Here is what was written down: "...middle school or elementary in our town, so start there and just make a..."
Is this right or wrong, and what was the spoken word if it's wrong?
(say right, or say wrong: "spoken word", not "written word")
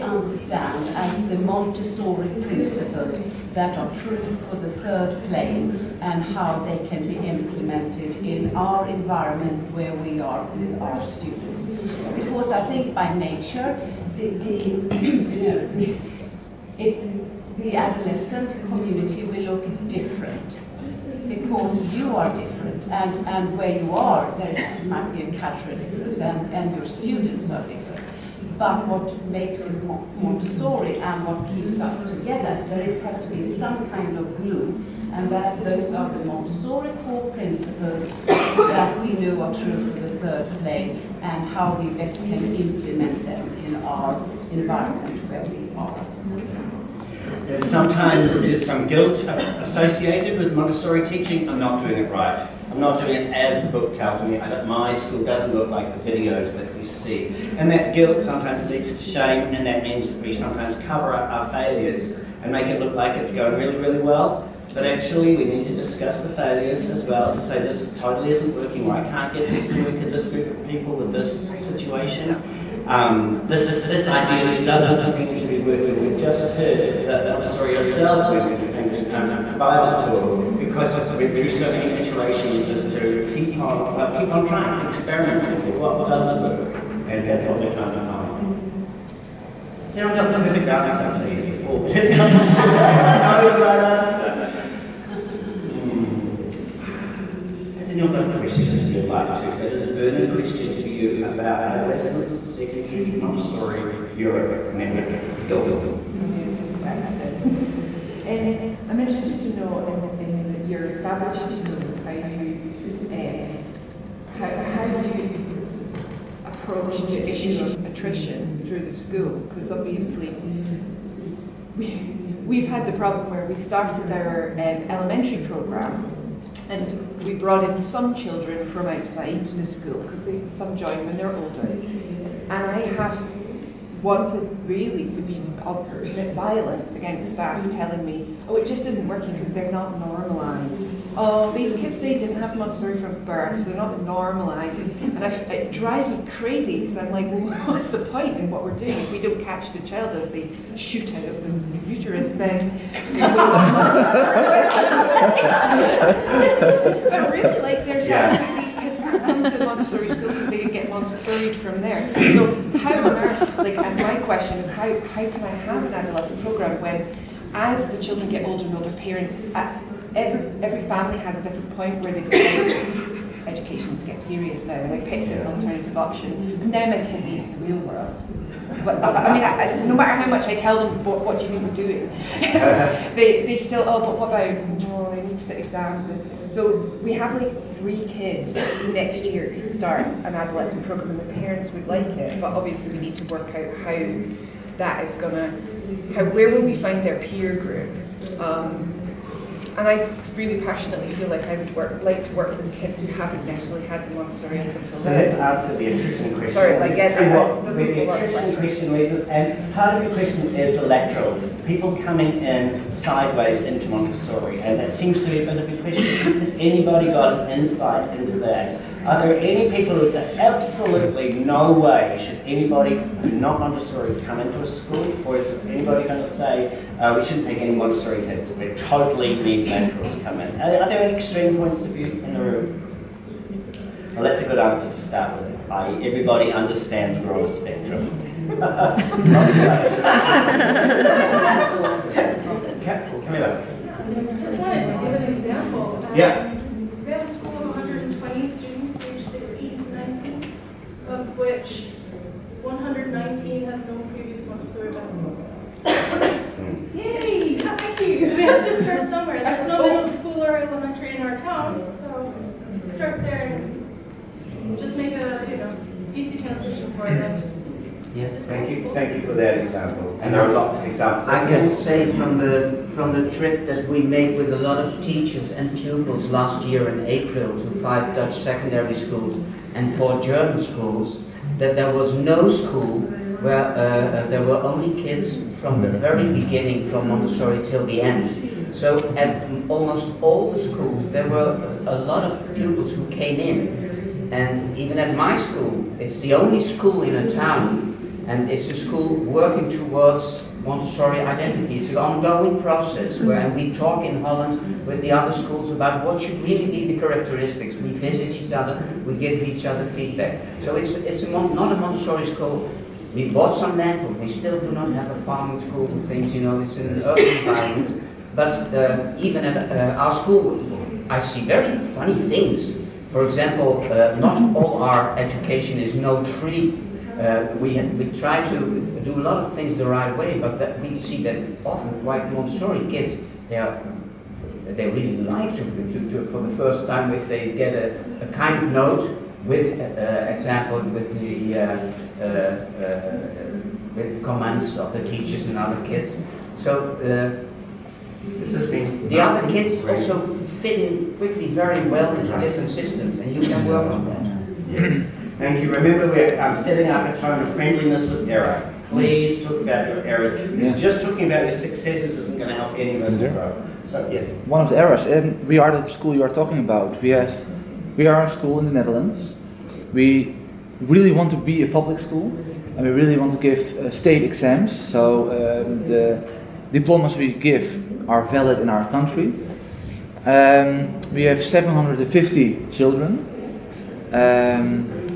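right.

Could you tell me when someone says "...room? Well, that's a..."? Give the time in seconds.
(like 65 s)
232 s.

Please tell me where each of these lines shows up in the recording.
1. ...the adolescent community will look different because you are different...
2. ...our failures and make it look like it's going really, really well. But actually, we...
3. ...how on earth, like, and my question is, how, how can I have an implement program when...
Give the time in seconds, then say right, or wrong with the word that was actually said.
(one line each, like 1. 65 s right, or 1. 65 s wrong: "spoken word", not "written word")
1. 17 s right
2. 61 s right
3. 162 s wrong: "adolescent", not "implement".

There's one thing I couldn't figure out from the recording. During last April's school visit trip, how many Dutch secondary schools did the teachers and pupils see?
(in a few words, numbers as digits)
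5.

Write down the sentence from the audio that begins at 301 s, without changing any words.
It's an ongoing process where mm-hmm.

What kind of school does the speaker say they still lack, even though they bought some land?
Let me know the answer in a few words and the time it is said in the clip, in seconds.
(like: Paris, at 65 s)
farming school, at 315 s.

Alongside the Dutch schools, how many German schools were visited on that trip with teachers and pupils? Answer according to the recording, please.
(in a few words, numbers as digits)
4.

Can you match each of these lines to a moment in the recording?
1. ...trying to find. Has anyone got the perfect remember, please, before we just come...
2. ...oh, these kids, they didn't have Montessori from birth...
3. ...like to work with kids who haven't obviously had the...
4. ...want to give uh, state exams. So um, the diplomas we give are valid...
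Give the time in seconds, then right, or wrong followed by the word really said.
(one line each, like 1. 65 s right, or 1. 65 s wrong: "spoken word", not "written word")
1. 87 s wrong: "answer", not "remember"
2. 141 s right
3. 202 s wrong: "necessarily", not "obviously"
4. 373 s right.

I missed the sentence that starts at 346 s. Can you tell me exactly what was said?
So the other kids also fit in quickly very well into different systems, and you can work on that.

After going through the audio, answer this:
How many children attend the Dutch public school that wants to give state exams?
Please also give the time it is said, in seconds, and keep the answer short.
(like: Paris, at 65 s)
750, at 381 s.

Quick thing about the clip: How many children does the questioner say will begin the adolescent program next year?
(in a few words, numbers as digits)
3.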